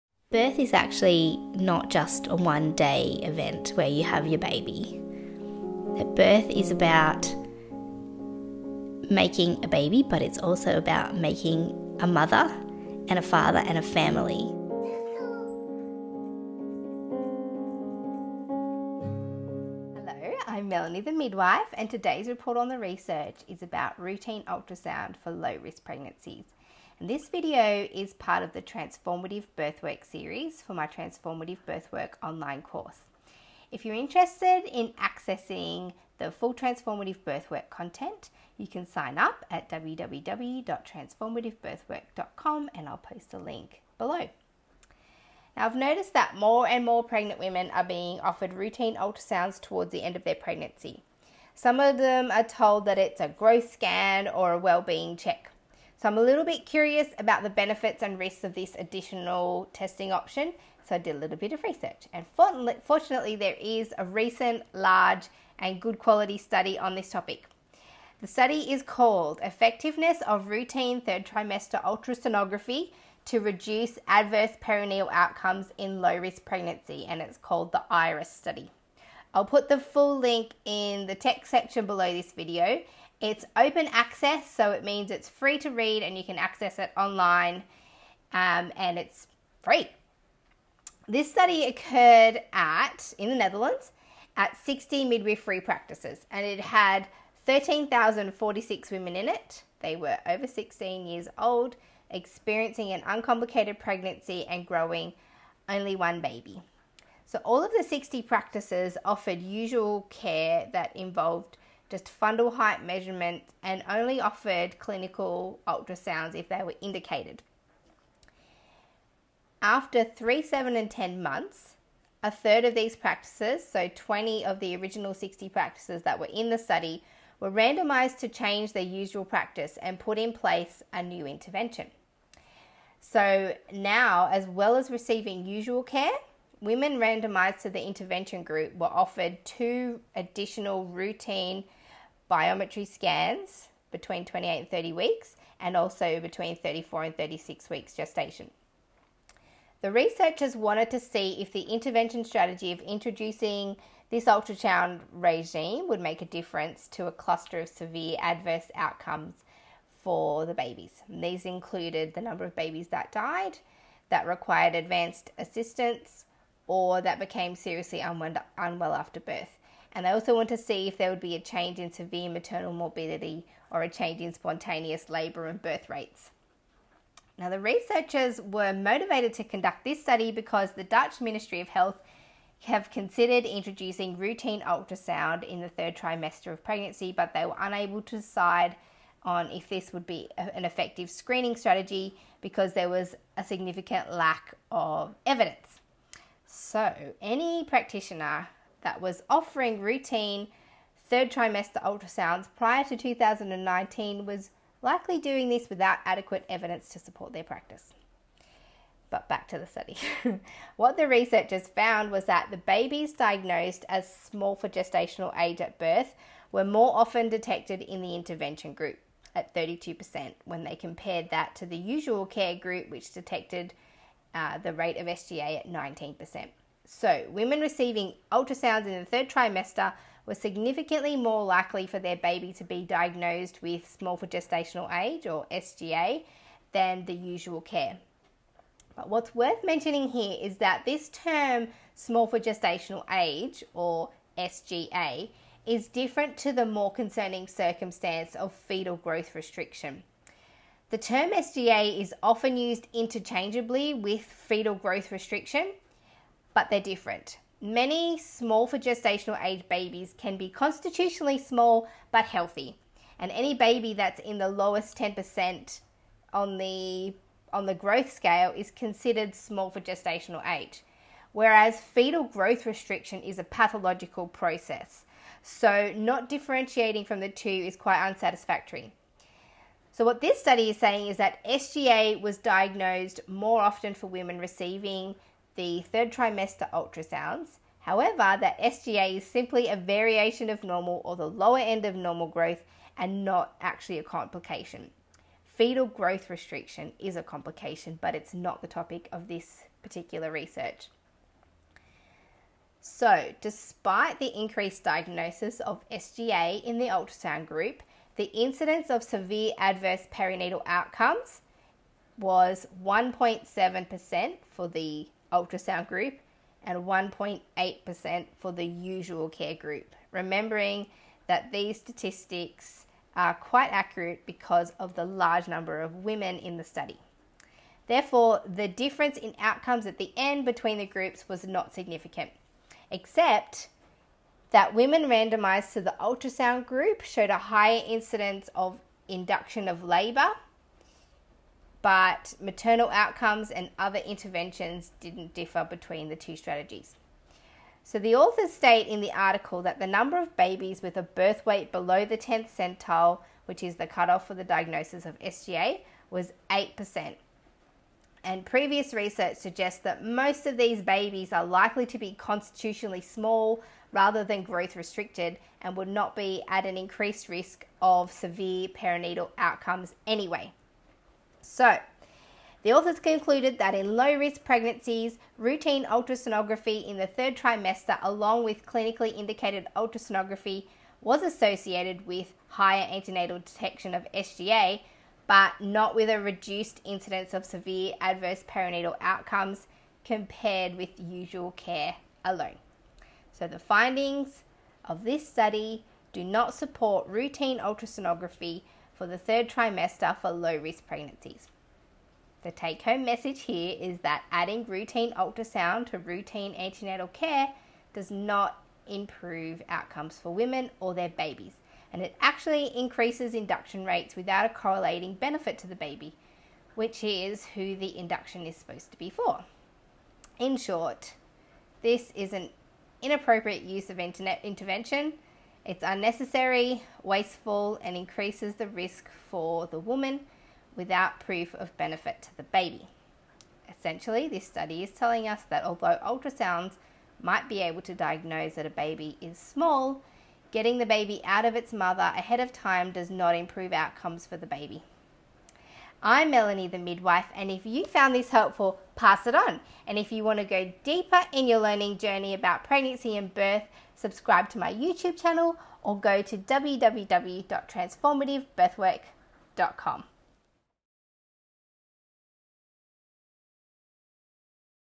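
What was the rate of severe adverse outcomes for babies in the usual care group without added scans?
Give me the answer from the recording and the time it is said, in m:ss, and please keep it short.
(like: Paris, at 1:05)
1.8%, at 5:16.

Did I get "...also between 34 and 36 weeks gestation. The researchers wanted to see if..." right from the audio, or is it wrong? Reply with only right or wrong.
right.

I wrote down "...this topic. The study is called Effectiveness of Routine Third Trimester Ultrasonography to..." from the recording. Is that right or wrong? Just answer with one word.
right.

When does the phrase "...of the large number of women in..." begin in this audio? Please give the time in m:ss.
5:24.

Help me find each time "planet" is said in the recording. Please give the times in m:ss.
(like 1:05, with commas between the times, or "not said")
not said.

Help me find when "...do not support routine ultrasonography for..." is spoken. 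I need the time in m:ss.
6:36.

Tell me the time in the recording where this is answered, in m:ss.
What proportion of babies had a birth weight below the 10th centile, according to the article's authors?
5:56.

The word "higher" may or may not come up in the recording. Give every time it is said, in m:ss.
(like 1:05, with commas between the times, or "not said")
5:37, 6:22.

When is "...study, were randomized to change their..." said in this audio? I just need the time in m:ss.
2:06.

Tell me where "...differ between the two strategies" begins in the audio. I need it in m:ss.
5:45.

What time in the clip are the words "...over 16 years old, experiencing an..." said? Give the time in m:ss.
1:40.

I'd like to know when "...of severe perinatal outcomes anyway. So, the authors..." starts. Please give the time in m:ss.
6:07.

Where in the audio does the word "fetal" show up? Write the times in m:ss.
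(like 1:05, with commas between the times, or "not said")
4:08, 4:14, 4:31, 4:55.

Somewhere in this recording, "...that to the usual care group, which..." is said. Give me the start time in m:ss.
3:41.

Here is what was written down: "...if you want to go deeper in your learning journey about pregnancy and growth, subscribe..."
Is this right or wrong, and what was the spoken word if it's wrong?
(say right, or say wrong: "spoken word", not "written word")
wrong: "birth", not "growth".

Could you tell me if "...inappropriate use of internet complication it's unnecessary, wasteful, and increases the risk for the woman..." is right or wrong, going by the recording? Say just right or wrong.
wrong.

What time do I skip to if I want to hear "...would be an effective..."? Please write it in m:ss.
3:09.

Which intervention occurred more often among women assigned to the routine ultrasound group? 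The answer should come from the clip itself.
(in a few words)
induction of labor.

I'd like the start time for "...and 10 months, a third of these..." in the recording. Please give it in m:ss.
2:00.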